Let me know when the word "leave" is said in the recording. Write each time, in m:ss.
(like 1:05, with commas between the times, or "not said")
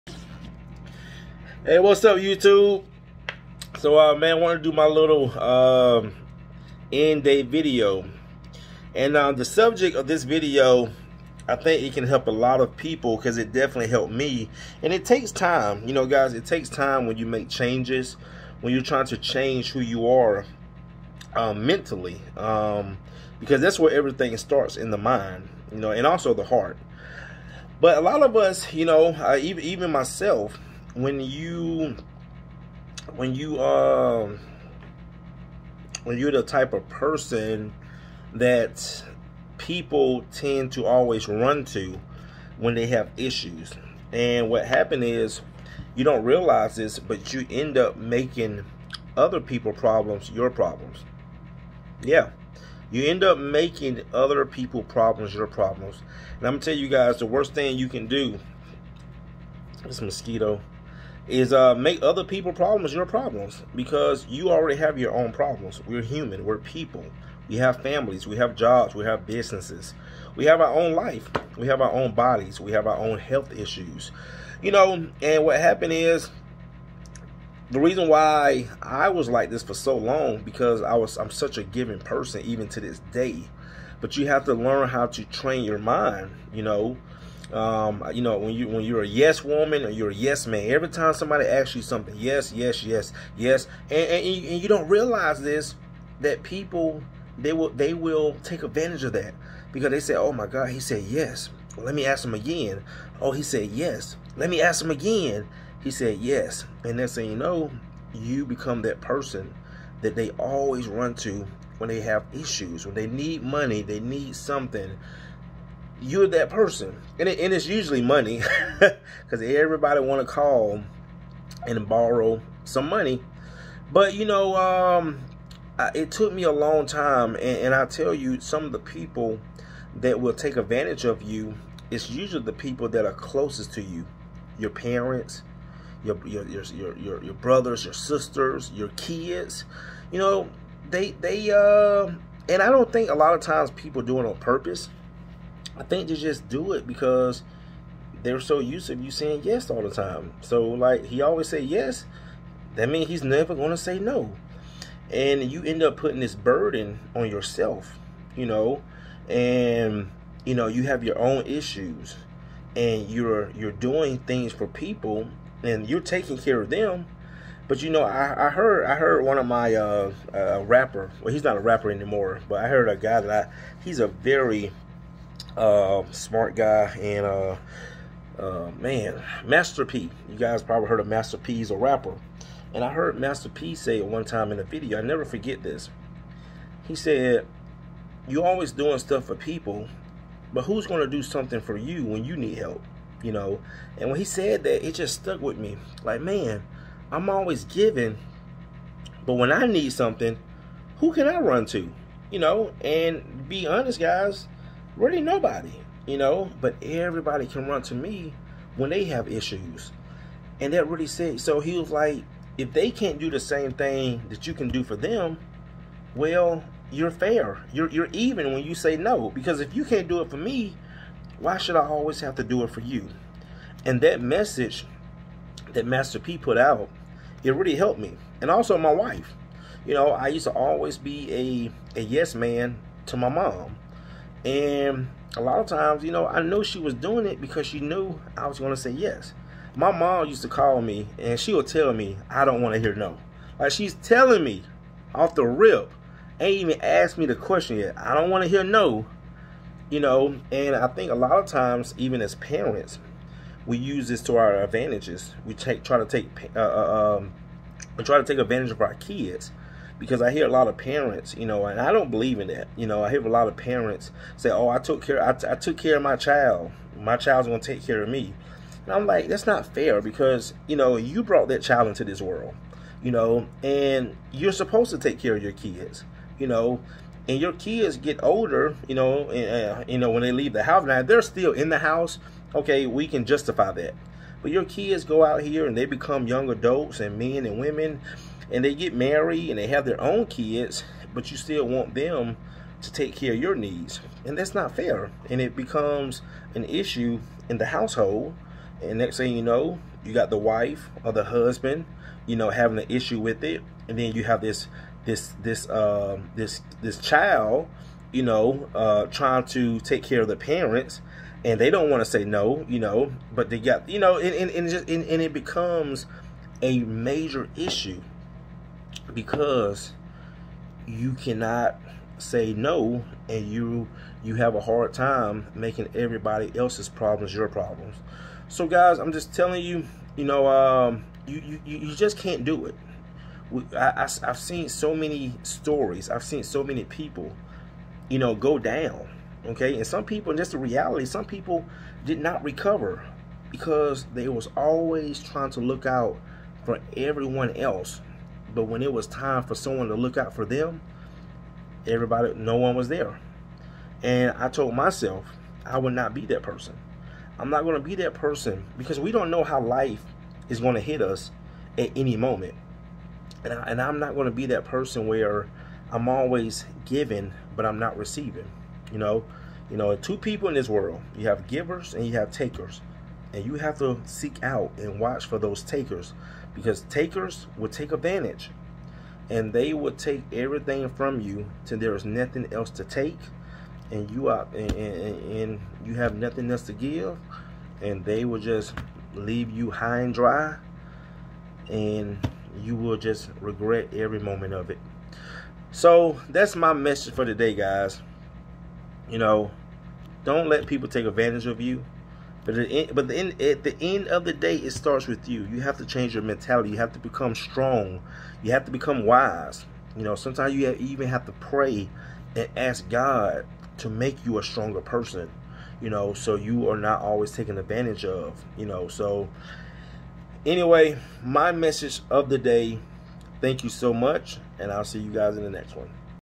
4:40, 6:29.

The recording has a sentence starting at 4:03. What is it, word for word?
Like she's telling me off the rip, ain't even asked me the question yet.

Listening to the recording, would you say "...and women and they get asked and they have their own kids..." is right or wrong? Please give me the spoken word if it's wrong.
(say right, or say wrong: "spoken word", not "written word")
wrong: "married", not "asked".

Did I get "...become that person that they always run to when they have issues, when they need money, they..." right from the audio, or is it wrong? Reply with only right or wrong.
right.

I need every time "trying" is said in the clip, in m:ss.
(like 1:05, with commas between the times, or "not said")
0:18, 5:09, 5:45.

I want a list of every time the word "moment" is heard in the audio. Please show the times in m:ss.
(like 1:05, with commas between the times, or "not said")
6:02, 6:34.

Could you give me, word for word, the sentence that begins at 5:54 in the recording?
And I told myself I would not be that person.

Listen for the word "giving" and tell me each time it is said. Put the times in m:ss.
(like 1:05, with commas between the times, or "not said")
1:21, 3:17, 6:06.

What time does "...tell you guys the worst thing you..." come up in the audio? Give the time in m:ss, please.
0:56.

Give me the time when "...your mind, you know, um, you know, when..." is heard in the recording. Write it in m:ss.
1:25.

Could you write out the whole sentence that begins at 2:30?
So like he always say yes, that means he's never gonna say no.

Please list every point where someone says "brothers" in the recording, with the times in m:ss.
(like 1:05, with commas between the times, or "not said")
2:17.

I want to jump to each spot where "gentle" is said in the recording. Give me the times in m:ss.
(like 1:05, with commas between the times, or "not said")
not said.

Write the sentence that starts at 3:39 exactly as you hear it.
Because if you can't do it for me, why should I always have to do it for you?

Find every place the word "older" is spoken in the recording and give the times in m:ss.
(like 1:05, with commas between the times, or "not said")
4:38.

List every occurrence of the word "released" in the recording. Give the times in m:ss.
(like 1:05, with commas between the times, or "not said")
not said.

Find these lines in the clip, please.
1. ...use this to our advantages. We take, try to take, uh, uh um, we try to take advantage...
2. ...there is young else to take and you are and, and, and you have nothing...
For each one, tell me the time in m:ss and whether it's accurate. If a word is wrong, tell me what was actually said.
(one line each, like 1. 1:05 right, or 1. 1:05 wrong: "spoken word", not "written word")
1. 4:13 right
2. 6:21 wrong: "nothing", not "young".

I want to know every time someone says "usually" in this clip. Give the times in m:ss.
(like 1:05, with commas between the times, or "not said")
1:57, 2:12.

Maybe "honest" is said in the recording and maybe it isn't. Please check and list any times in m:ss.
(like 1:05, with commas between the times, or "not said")
3:23.